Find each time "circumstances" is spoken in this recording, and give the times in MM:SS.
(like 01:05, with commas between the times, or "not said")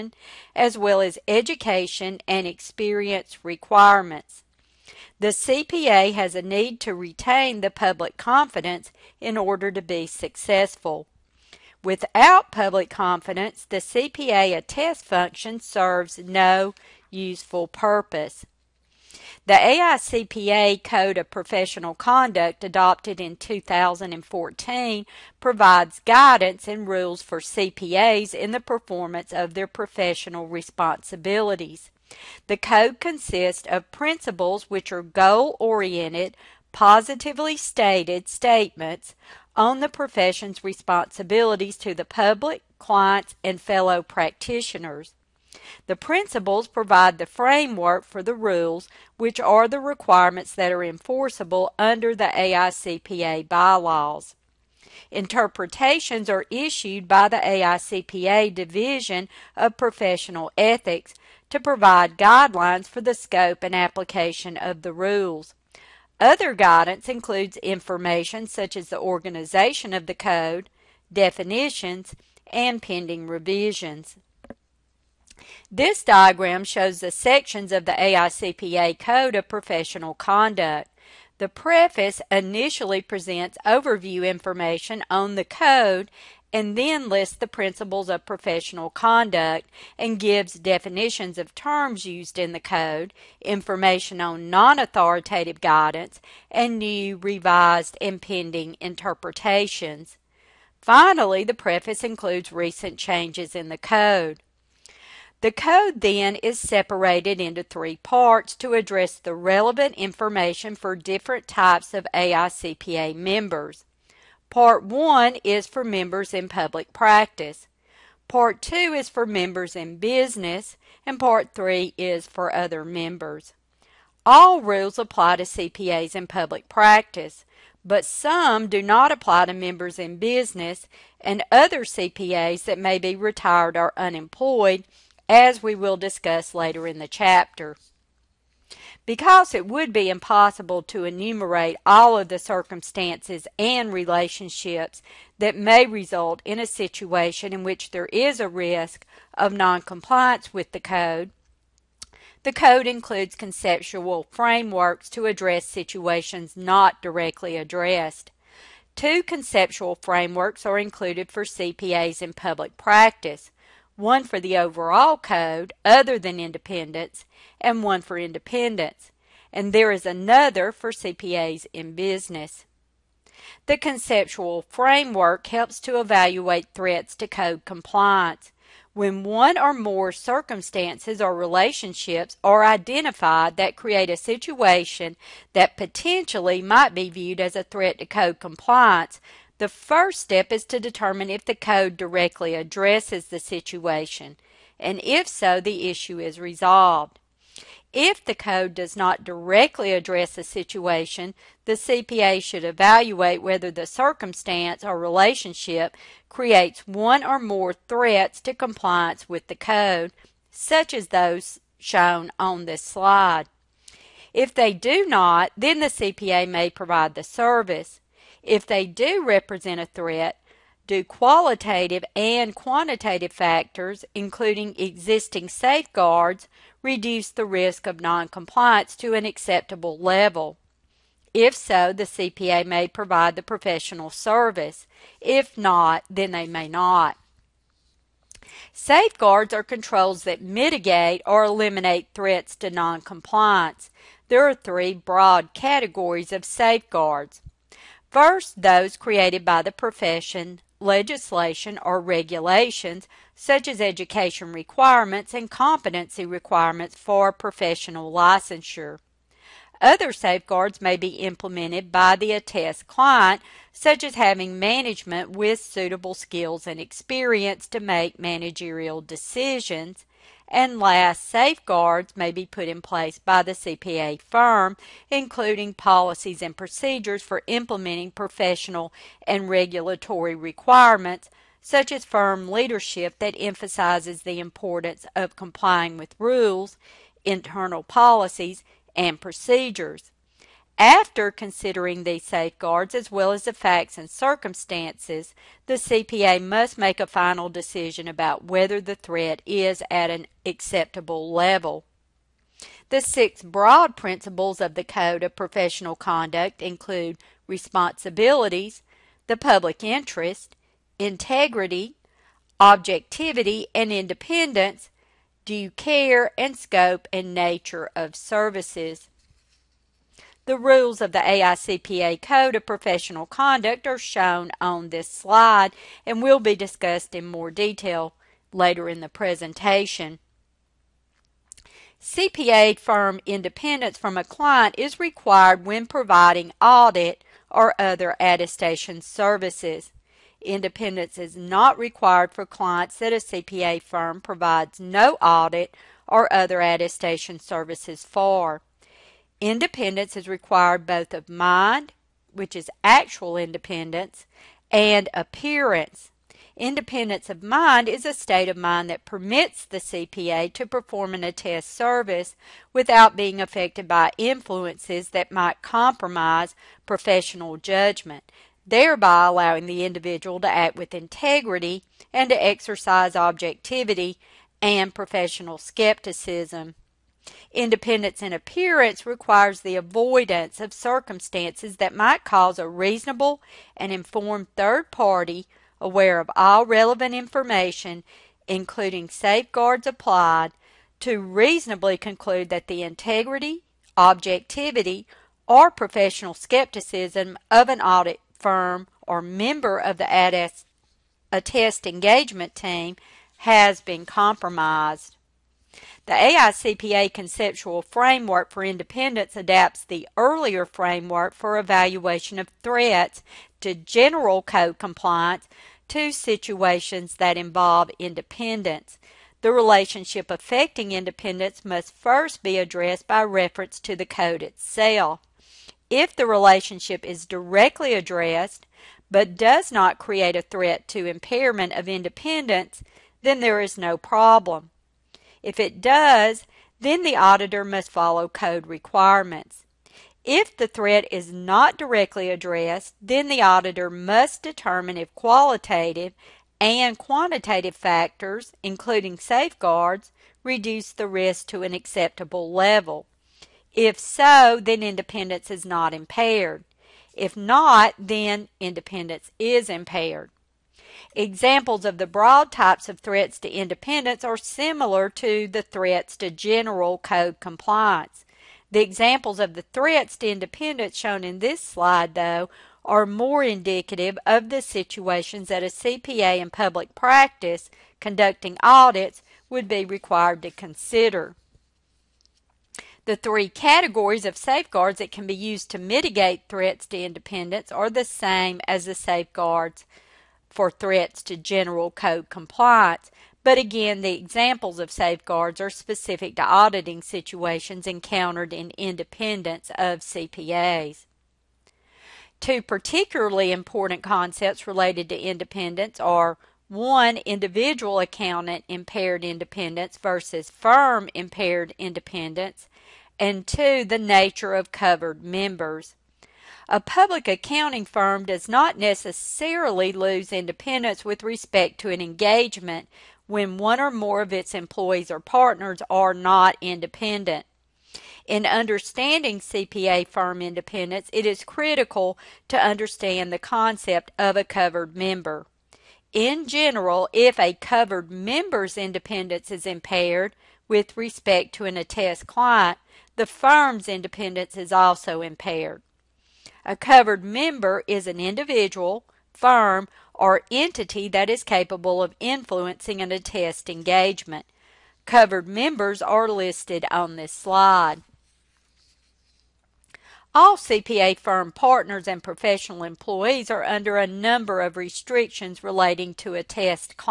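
02:22, 03:00, 03:23, 04:54, 06:20.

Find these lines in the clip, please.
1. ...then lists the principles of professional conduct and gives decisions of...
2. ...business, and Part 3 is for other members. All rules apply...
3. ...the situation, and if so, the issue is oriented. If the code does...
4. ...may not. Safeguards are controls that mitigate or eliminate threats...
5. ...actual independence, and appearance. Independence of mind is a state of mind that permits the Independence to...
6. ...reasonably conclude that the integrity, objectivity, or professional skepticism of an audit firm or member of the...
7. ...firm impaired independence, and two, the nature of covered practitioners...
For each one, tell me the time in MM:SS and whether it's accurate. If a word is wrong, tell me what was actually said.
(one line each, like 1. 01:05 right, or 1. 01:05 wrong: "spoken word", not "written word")
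1. 01:26 wrong: "definitions", not "decisions"
2. 01:59 right
3. 03:13 wrong: "resolved", not "oriented"
4. 03:56 right
5. 05:52 wrong: "CPA", not "Independence"
6. 06:31 right
7. 08:30 wrong: "members", not "practitioners".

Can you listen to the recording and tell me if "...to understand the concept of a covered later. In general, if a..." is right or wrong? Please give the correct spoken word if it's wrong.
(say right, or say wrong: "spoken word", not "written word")
wrong: "member", not "later".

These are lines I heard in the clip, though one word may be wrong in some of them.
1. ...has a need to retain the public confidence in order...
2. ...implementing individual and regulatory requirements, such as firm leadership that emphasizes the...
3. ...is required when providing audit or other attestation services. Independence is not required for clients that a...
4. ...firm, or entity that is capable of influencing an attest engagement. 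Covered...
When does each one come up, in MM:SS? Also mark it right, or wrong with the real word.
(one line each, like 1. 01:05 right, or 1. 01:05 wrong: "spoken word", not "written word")
1. 00:06 right
2. 04:37 wrong: "professional", not "individual"
3. 05:34 right
4. 09:09 right.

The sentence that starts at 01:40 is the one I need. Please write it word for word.
Finally, the preface includes recent changes in the code.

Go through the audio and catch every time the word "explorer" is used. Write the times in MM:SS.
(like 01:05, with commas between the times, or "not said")
not said.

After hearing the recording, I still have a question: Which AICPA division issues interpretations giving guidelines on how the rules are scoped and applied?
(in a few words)
Division of Professional Ethics.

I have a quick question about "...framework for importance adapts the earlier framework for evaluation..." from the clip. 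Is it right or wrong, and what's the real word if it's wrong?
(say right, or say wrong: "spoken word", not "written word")
wrong: "independence", not "importance".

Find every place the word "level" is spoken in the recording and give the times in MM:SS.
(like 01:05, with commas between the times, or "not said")
03:49, 05:01, 07:32.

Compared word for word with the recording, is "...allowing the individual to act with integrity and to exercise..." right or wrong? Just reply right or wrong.
right.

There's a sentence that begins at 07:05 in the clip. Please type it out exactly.
If the relationship is directly addressed, but does not create a threat to impairment of independence, then there is no problem.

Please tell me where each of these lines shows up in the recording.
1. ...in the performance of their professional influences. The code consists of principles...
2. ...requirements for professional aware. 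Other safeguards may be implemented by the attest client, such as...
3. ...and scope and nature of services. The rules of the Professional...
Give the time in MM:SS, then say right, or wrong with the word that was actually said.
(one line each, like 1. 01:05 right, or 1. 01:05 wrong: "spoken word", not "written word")
1. 00:28 wrong: "responsibilities", not "influences"
2. 04:16 wrong: "licensure", not "aware"
3. 05:16 wrong: "AICPA", not "Professional".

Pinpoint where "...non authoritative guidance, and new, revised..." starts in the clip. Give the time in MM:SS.
01:34.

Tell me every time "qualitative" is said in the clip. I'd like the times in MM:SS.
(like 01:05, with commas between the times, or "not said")
03:41, 07:25.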